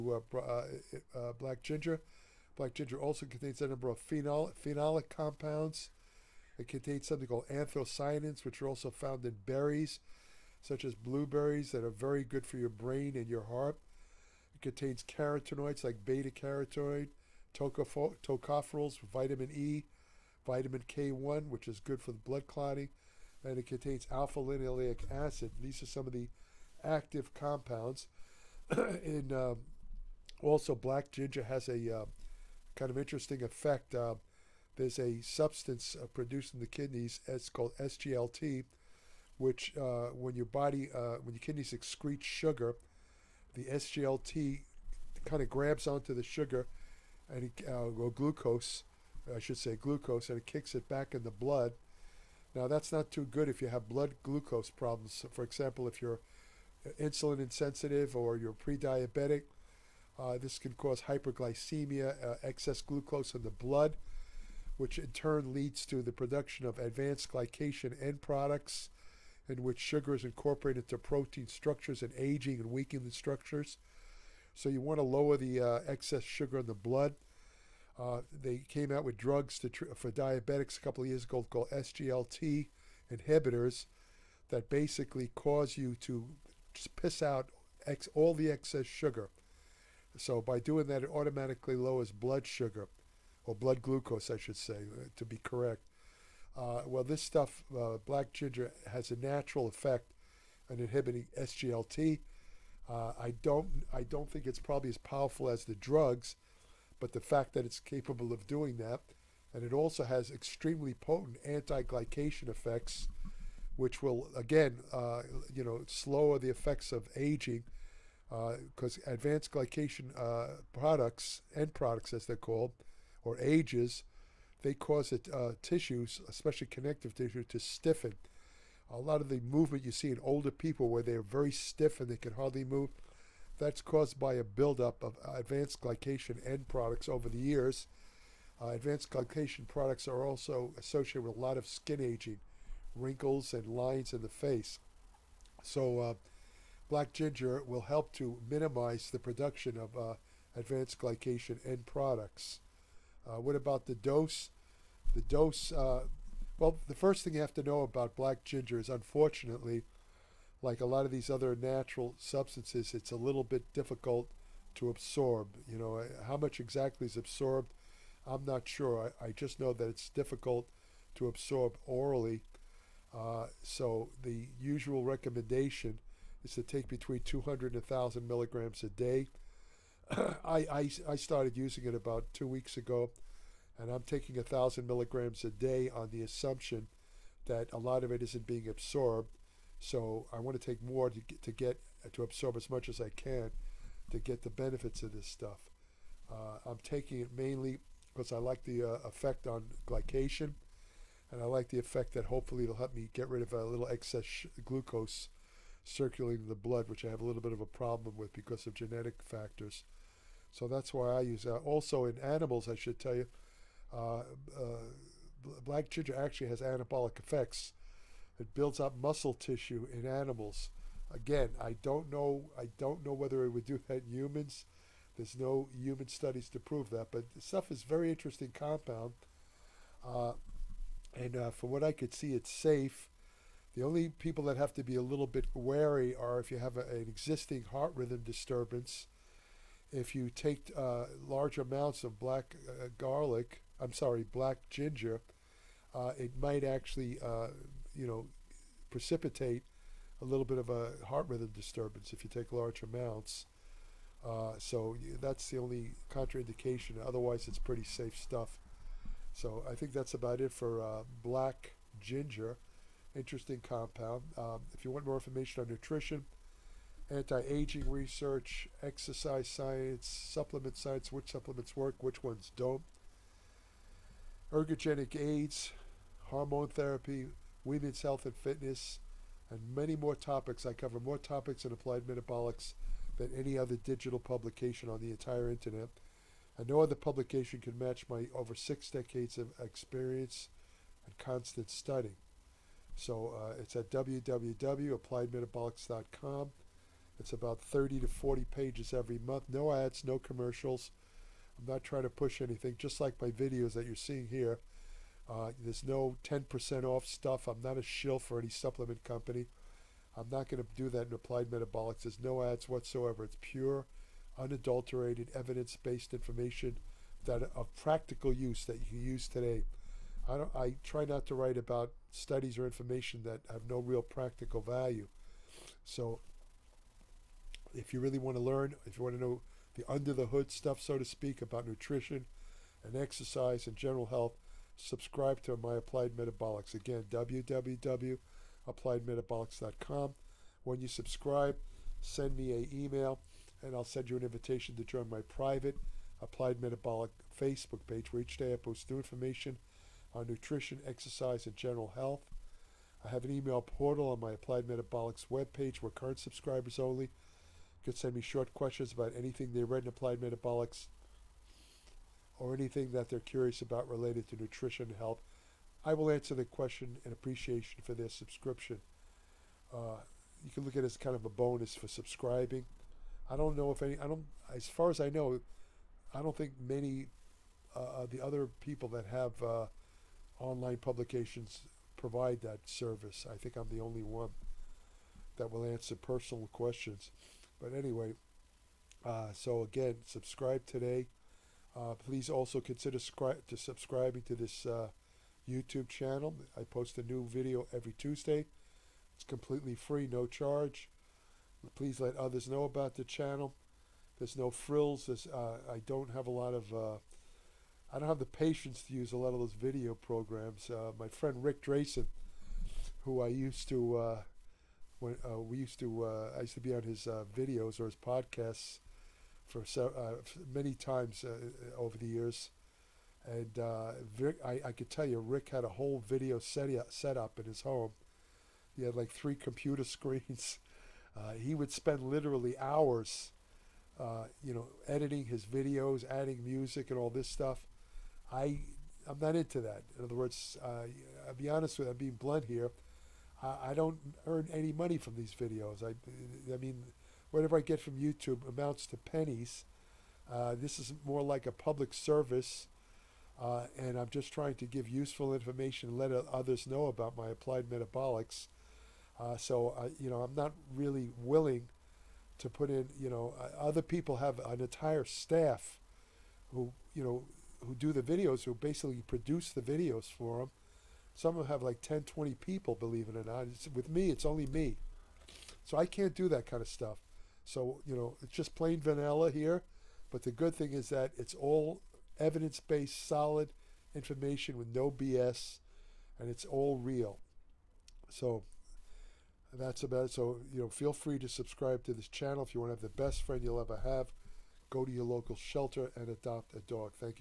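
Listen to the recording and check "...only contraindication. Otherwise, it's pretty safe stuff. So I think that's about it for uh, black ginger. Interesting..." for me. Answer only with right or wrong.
right.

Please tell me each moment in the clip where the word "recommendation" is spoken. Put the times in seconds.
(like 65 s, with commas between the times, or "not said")
175 s.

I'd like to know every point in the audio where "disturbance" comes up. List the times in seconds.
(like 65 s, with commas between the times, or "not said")
238 s, 251 s.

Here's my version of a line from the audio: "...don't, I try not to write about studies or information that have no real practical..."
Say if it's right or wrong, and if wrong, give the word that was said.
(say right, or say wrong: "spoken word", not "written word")
right.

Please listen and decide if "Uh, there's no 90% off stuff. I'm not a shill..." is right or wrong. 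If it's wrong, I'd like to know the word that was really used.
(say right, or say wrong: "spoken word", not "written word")
wrong: "10", not "90".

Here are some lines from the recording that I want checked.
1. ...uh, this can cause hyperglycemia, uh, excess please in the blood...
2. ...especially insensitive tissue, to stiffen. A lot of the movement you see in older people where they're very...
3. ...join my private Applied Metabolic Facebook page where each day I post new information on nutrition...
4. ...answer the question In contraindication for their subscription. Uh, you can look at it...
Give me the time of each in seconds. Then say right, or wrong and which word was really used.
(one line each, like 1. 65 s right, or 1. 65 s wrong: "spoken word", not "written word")
1. 60 s wrong: "glucose", not "please"
2. 126 s wrong: "connective", not "insensitive"
3. 344 s right
4. 366 s wrong: "appreciation", not "contraindication".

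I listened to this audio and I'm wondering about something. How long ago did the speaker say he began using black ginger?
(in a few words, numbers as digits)
about two weeks.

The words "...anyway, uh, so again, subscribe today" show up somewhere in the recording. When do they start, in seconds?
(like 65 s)
387 s.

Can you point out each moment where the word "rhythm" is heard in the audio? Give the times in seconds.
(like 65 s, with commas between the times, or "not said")
237 s, 251 s.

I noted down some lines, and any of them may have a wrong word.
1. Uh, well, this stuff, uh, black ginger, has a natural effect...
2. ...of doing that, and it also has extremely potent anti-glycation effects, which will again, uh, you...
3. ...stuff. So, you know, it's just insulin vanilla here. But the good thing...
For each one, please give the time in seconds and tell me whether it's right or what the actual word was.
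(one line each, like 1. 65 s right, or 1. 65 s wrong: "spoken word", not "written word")
1. 96 s right
2. 108 s right
3. 476 s wrong: "plain", not "insulin".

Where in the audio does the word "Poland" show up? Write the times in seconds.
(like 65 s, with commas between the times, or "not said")
not said.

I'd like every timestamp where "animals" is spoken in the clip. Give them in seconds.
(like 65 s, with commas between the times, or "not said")
212 s, 220 s.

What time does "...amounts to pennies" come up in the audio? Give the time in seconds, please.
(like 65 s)
448 s.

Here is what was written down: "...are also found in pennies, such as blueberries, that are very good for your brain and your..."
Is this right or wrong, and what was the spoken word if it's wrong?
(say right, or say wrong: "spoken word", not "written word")
wrong: "berries", not "pennies".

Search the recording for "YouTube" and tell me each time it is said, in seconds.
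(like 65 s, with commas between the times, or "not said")
395 s, 447 s.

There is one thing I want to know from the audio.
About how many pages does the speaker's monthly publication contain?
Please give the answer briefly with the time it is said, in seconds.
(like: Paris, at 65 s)
30 to 40, at 297 s.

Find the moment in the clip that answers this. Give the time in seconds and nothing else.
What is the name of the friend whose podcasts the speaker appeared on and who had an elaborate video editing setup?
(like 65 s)
411 s.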